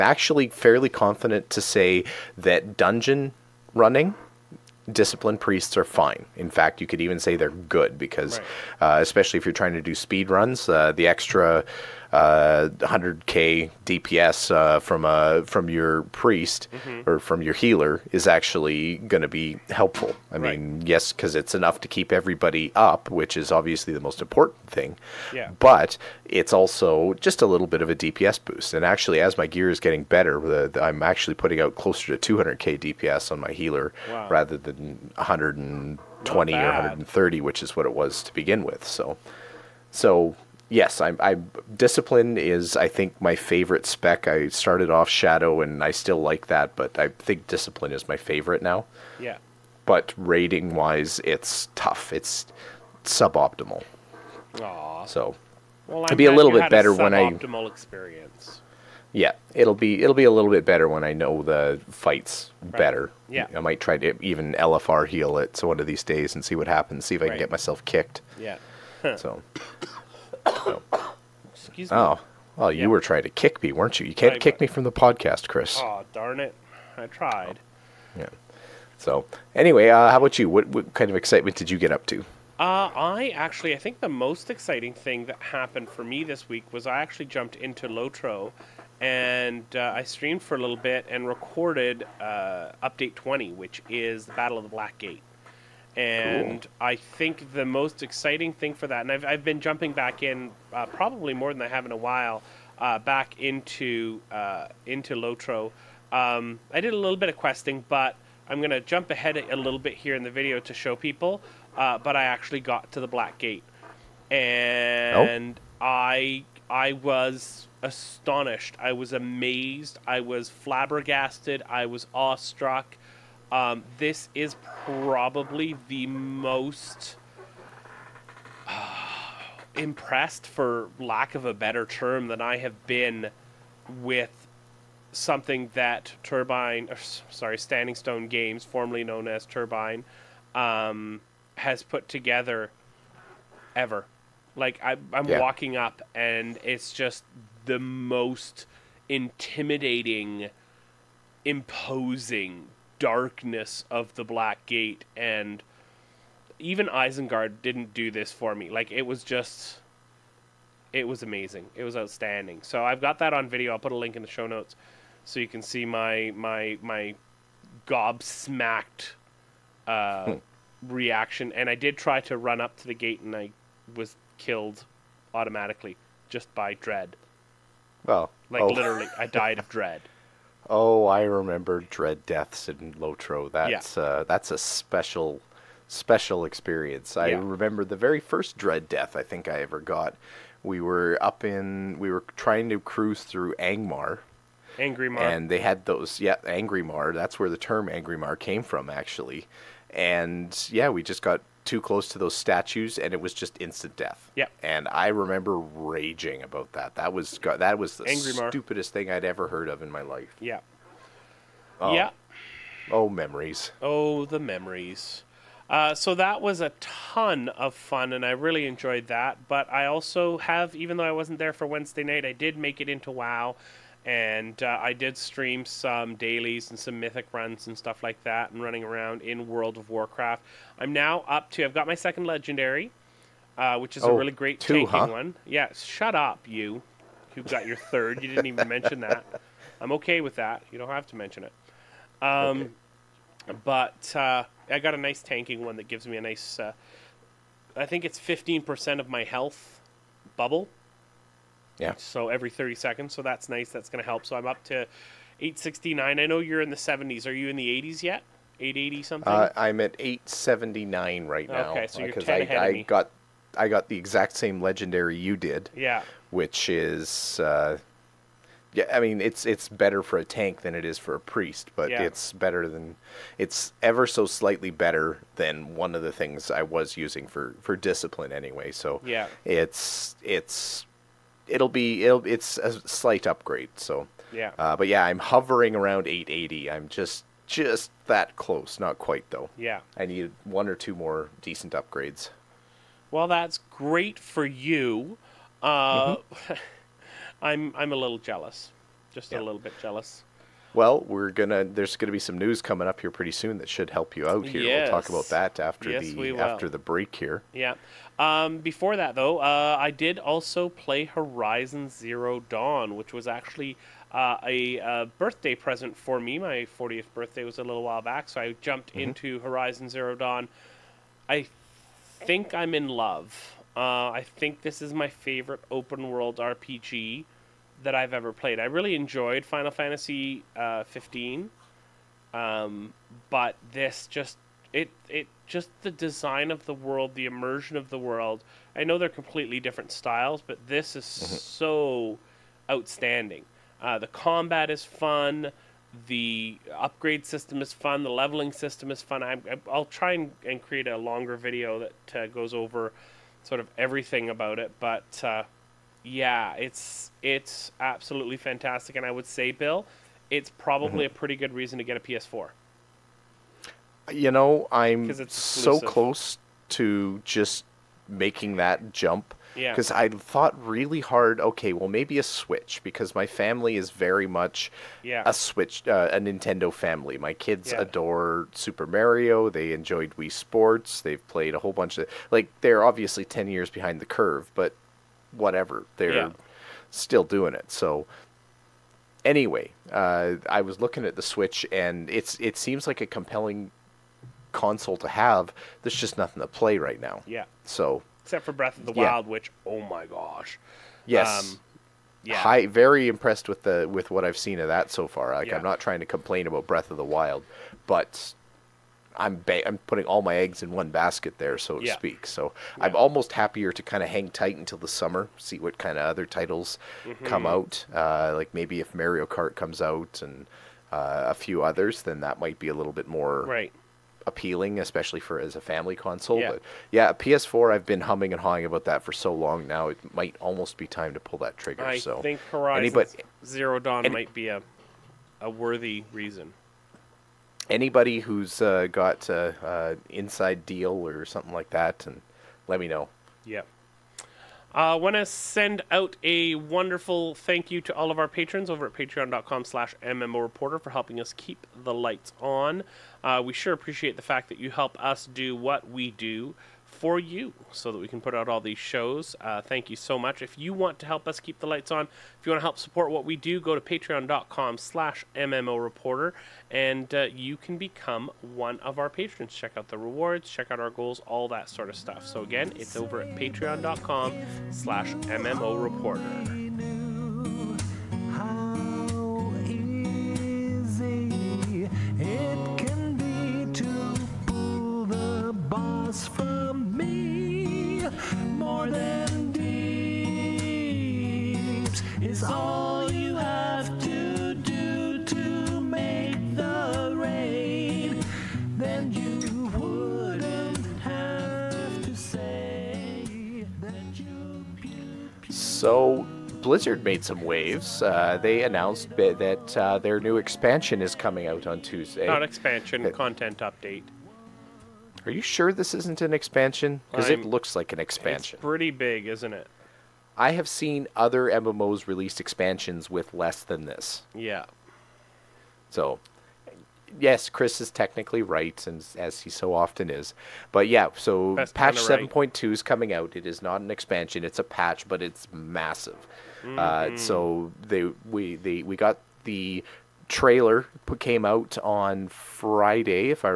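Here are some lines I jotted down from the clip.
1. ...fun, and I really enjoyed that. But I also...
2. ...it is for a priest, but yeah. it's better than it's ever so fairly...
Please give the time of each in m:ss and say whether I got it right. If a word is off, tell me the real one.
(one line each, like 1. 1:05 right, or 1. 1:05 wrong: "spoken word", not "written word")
1. 3:37 right
2. 4:30 wrong: "slightly", not "fairly".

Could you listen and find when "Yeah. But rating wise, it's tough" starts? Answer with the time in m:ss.
0:49.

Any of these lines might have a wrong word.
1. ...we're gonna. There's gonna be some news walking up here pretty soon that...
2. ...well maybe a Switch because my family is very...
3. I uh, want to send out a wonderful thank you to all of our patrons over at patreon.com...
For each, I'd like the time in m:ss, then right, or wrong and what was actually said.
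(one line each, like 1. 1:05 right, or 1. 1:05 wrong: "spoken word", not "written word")
1. 5:01 wrong: "coming", not "walking"
2. 6:11 right
3. 7:24 right.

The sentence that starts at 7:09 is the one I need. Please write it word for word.
It might almost be time to pull that trigger.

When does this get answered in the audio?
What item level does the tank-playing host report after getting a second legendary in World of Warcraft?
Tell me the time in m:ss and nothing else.
4:15.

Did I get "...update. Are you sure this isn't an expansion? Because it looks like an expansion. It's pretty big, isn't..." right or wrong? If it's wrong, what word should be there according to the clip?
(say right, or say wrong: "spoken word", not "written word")
right.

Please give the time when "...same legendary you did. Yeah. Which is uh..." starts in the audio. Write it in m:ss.
4:24.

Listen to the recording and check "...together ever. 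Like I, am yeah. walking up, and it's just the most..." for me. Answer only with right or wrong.
right.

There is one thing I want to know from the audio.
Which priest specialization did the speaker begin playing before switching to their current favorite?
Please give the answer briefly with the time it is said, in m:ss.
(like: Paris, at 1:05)
Shadow, at 0:45.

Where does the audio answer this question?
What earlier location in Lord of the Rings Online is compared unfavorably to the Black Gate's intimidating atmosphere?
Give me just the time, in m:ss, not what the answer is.
2:36.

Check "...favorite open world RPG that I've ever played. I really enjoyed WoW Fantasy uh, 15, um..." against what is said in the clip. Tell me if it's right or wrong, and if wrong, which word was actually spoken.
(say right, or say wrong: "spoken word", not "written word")
wrong: "Final", not "WoW".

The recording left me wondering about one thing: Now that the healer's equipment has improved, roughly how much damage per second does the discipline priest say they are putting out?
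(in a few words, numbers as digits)
200k.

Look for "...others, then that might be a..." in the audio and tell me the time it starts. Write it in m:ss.
7:01.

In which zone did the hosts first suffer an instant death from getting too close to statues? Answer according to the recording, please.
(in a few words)
Angmar.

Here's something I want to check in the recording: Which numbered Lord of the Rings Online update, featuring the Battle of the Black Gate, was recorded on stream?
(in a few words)
Update 20.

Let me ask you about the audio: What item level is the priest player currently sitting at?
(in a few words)
879.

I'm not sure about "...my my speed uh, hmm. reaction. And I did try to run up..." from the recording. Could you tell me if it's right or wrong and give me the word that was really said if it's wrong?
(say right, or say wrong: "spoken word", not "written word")
wrong: "gobsmacked", not "speed".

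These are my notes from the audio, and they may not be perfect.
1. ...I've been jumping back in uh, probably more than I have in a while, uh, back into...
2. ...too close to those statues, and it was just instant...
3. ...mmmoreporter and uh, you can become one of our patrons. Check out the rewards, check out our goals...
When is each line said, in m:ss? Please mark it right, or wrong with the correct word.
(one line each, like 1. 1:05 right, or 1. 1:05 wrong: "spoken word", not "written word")
1. 1:39 right
2. 3:21 right
3. 7:45 right.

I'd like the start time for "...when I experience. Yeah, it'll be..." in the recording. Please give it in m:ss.
0:56.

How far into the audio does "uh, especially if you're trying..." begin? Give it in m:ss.
0:08.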